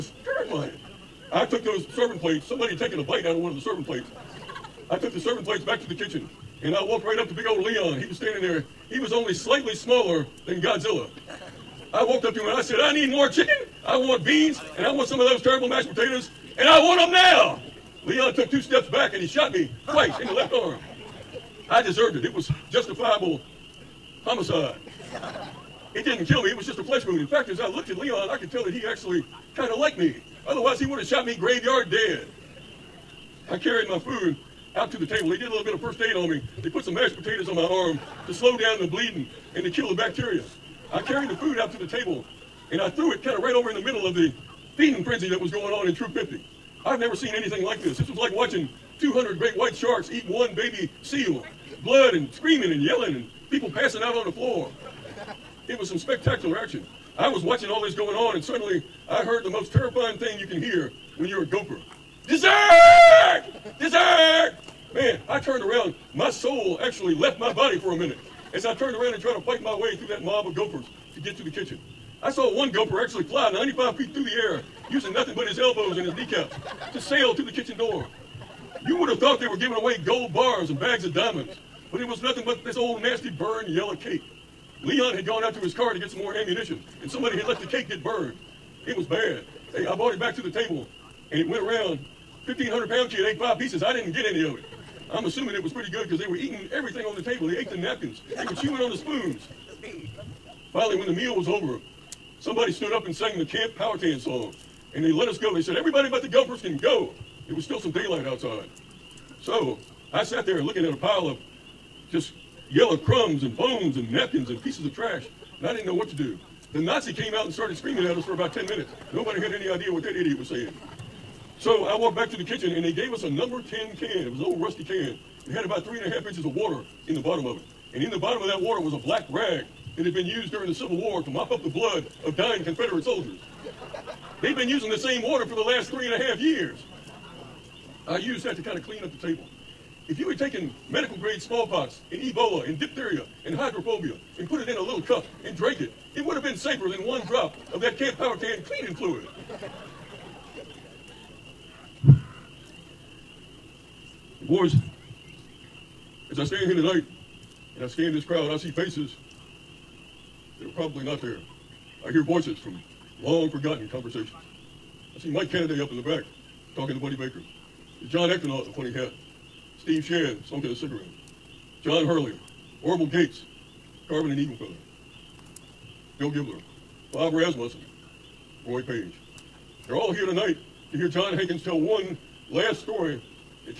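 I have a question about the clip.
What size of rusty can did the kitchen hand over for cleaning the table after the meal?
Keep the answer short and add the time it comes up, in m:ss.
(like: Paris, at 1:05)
number 10, at 2:03.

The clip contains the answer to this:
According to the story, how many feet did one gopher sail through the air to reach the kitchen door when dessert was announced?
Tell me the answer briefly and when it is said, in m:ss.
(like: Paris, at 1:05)
95, at 1:13.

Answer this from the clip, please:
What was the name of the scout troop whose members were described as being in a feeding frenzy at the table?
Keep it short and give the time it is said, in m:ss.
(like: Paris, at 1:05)
Troop 50, at 0:45.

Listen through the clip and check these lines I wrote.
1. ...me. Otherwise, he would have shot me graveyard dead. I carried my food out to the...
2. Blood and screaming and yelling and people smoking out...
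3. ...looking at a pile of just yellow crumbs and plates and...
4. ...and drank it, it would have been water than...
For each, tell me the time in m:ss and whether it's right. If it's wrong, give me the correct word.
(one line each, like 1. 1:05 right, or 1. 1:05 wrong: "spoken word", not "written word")
1. 0:29 right
2. 0:51 wrong: "passing", not "smoking"
3. 1:50 wrong: "bones", not "plates"
4. 2:25 wrong: "safer", not "water".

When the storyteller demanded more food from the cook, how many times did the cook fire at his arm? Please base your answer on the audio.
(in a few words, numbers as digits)
2.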